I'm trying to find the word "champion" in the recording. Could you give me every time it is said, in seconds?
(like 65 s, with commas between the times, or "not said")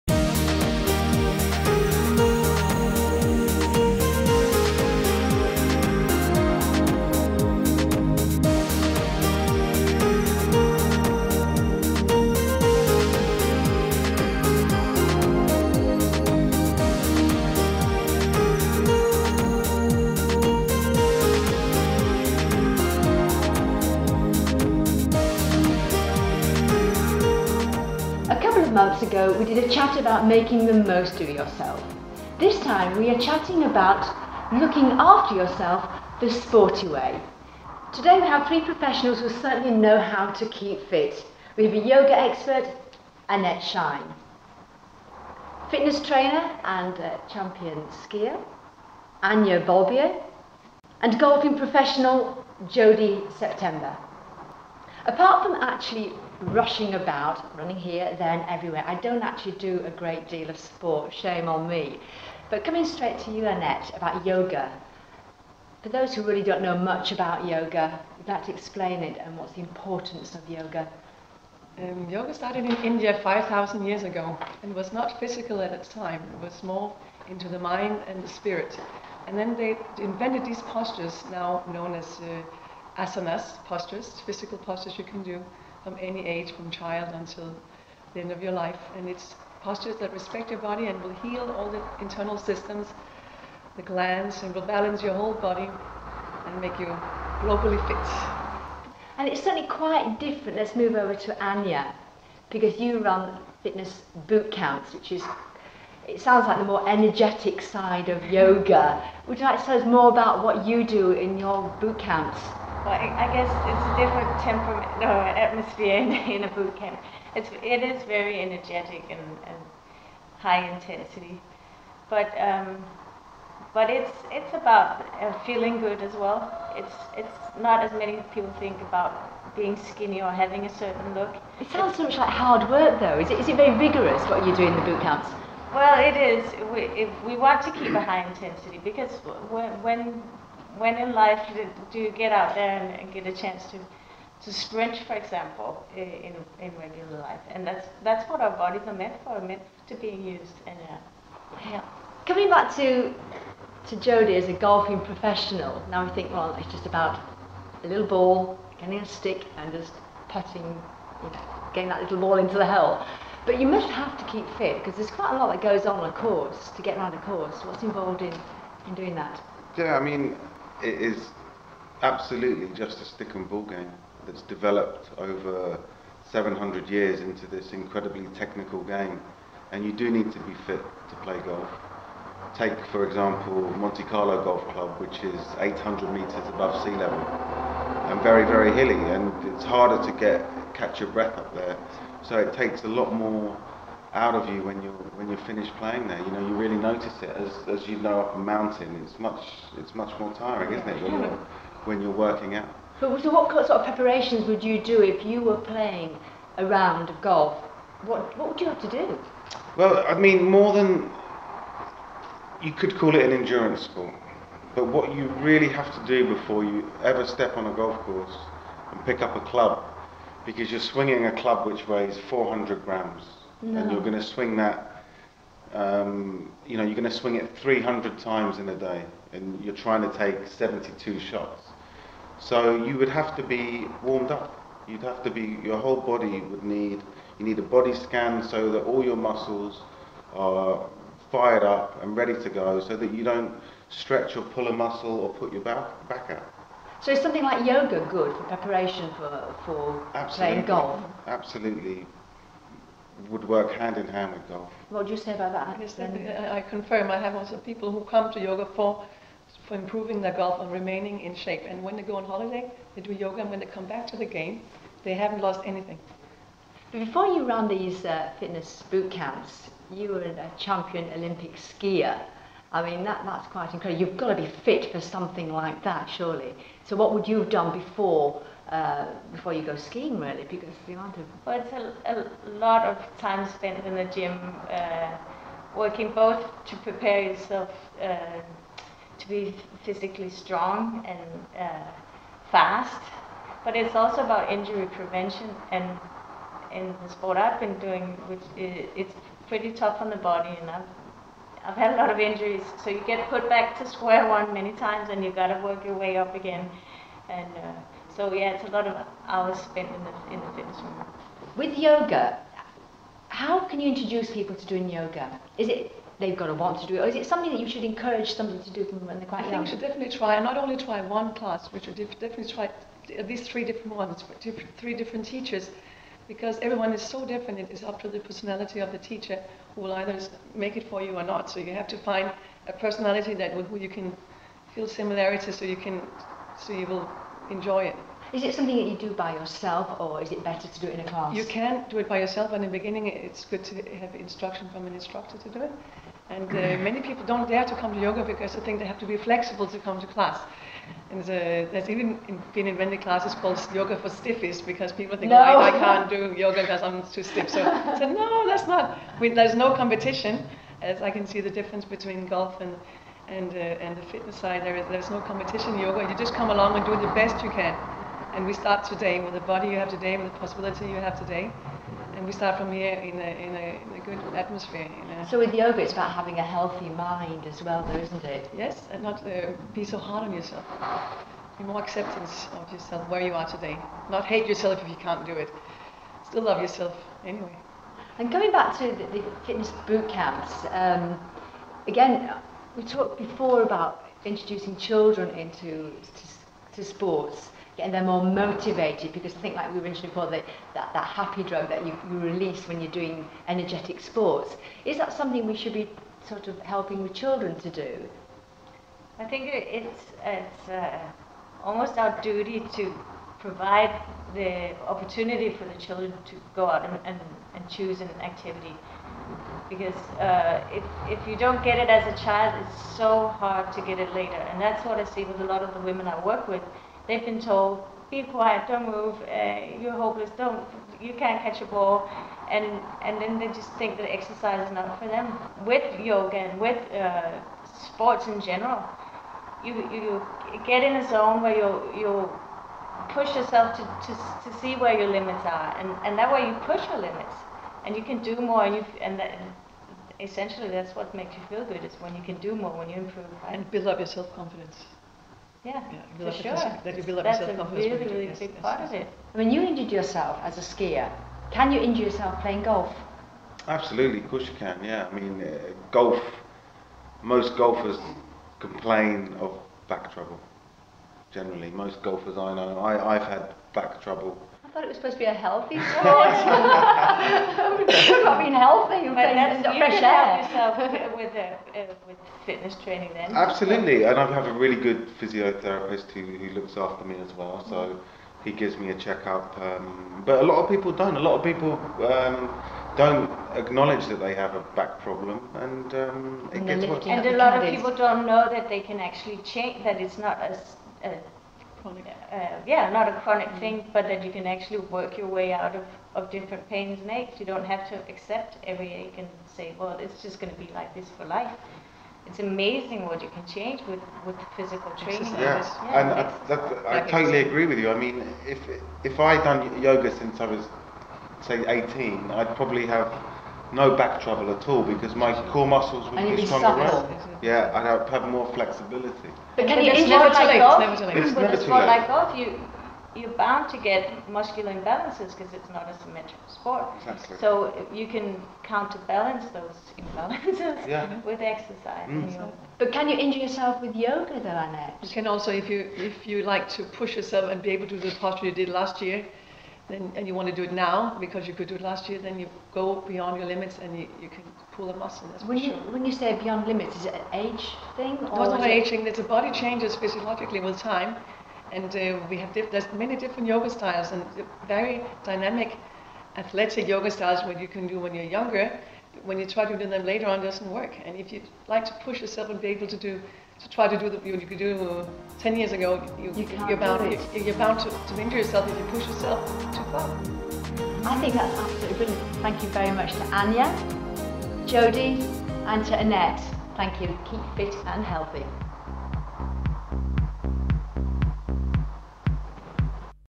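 47 s, 270 s.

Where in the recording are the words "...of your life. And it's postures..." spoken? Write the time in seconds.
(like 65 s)
88 s.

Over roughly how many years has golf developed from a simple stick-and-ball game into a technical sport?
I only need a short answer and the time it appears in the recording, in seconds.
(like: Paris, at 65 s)
700 years, at 176 s.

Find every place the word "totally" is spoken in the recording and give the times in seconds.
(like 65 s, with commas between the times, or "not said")
517 s.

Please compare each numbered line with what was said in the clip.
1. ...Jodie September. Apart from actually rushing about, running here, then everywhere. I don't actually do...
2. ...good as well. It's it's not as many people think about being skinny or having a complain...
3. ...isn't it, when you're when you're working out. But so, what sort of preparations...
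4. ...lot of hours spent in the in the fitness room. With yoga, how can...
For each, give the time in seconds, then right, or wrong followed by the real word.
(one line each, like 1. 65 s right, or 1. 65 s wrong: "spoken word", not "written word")
1. 52 s right
2. 125 s wrong: "certain", not "complain"
3. 200 s right
4. 308 s right.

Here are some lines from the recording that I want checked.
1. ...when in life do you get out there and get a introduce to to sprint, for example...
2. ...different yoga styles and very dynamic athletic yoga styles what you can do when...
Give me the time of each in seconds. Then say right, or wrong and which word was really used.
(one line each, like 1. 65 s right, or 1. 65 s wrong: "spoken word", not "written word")
1. 140 s wrong: "chance", not "introduce"
2. 563 s right.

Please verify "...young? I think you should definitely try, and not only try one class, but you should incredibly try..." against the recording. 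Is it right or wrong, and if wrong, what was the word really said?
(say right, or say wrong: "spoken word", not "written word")
wrong: "definitely", not "incredibly".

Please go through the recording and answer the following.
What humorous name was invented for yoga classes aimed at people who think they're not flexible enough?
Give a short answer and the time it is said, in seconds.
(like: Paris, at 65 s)
yoga for stiffies, at 353 s.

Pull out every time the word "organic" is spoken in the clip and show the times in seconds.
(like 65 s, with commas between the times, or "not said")
not said.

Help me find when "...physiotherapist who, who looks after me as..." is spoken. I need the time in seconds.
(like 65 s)
485 s.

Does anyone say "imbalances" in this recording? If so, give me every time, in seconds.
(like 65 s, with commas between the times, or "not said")
534 s, 539 s.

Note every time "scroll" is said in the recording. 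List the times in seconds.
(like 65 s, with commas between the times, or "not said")
not said.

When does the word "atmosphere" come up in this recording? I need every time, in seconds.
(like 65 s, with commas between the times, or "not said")
115 s, 374 s.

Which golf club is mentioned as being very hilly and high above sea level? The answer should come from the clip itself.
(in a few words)
Monte Carlo Golf Club.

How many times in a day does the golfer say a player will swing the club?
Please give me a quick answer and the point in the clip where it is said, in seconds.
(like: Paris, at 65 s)
300, at 227 s.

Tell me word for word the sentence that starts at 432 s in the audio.
And, and then they just think that exercise is not for them.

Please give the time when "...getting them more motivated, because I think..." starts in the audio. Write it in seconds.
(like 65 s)
397 s.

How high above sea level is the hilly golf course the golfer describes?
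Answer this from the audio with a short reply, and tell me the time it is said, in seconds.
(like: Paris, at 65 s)
800 meters, at 185 s.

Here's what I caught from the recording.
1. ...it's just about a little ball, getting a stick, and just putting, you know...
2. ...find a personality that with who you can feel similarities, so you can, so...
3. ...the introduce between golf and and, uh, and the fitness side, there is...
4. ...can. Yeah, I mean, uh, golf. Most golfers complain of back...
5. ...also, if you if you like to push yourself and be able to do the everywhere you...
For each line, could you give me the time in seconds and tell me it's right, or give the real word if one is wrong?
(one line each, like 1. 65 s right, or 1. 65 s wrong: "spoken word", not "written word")
1. 156 s right
2. 331 s right
3. 361 s wrong: "difference", not "introduce"
4. 464 s right
5. 545 s wrong: "posture", not "everywhere".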